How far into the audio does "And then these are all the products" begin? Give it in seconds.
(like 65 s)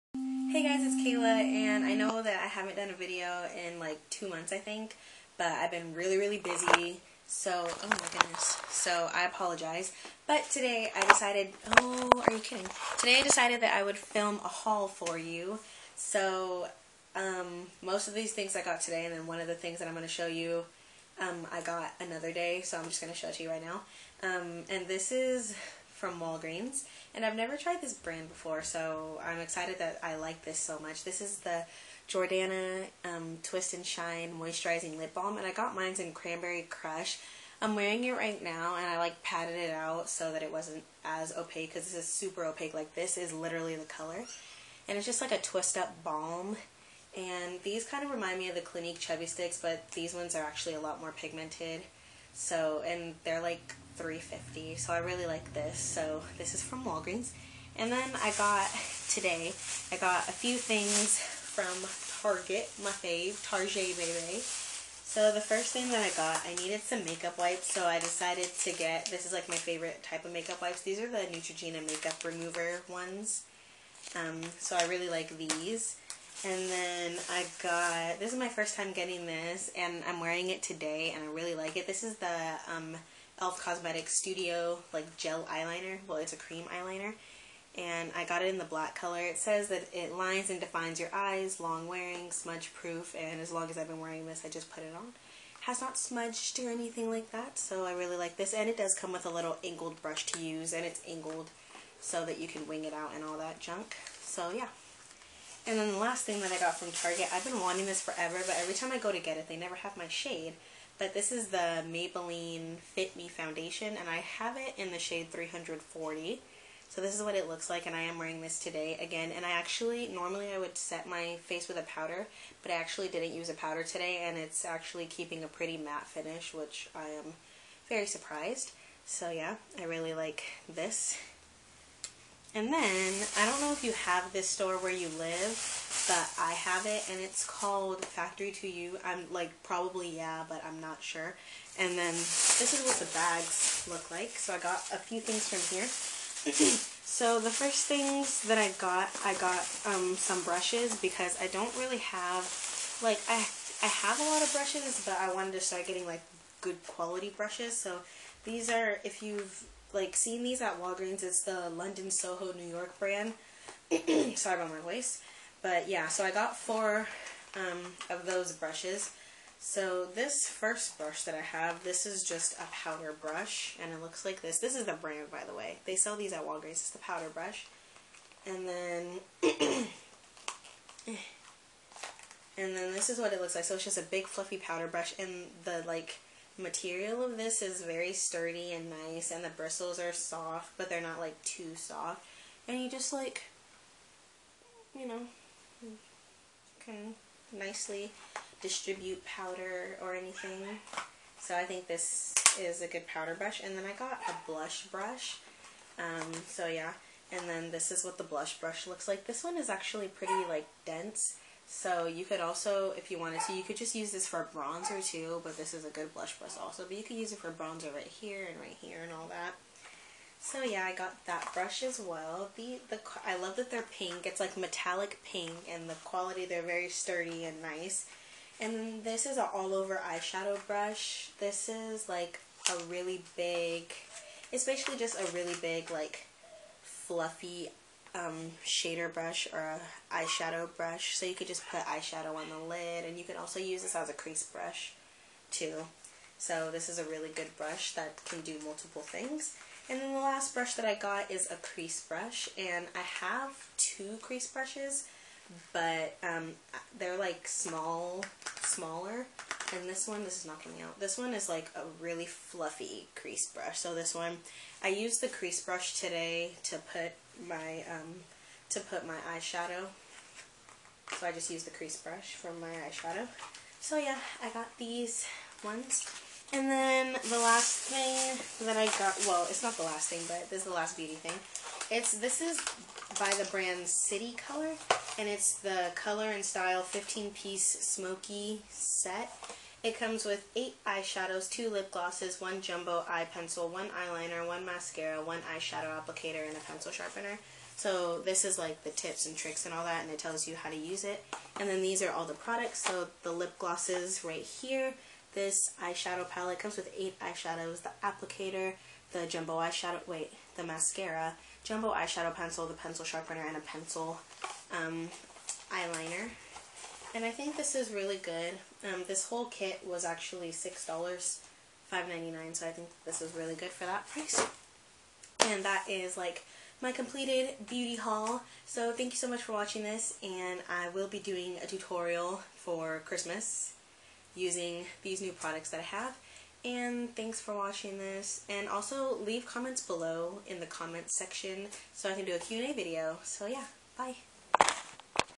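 301 s.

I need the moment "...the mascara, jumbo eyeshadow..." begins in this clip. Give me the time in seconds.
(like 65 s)
310 s.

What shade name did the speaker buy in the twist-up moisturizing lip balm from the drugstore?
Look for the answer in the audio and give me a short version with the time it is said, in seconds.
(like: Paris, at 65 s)
Cranberry Crush, at 36 s.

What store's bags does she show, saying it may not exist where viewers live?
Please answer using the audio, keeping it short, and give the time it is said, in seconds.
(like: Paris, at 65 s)
Factory to You, at 138 s.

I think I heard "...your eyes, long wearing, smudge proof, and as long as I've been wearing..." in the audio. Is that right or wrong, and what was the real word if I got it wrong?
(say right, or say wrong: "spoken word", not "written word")
right.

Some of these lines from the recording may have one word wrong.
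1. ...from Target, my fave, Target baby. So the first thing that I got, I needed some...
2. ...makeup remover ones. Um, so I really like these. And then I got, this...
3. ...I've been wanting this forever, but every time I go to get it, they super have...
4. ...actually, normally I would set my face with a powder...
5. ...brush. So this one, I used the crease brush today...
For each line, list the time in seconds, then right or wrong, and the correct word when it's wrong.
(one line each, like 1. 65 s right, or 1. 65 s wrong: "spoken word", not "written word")
1. 61 s right
2. 71 s right
3. 107 s wrong: "never", not "super"
4. 119 s right
5. 263 s right.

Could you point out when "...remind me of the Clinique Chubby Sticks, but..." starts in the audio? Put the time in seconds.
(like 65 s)
48 s.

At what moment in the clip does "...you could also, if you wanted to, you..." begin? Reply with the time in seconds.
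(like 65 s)
212 s.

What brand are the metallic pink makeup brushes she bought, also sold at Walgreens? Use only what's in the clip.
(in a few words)
London Soho New York.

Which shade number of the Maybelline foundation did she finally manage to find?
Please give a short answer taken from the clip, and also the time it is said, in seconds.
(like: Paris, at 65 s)
340, at 115 s.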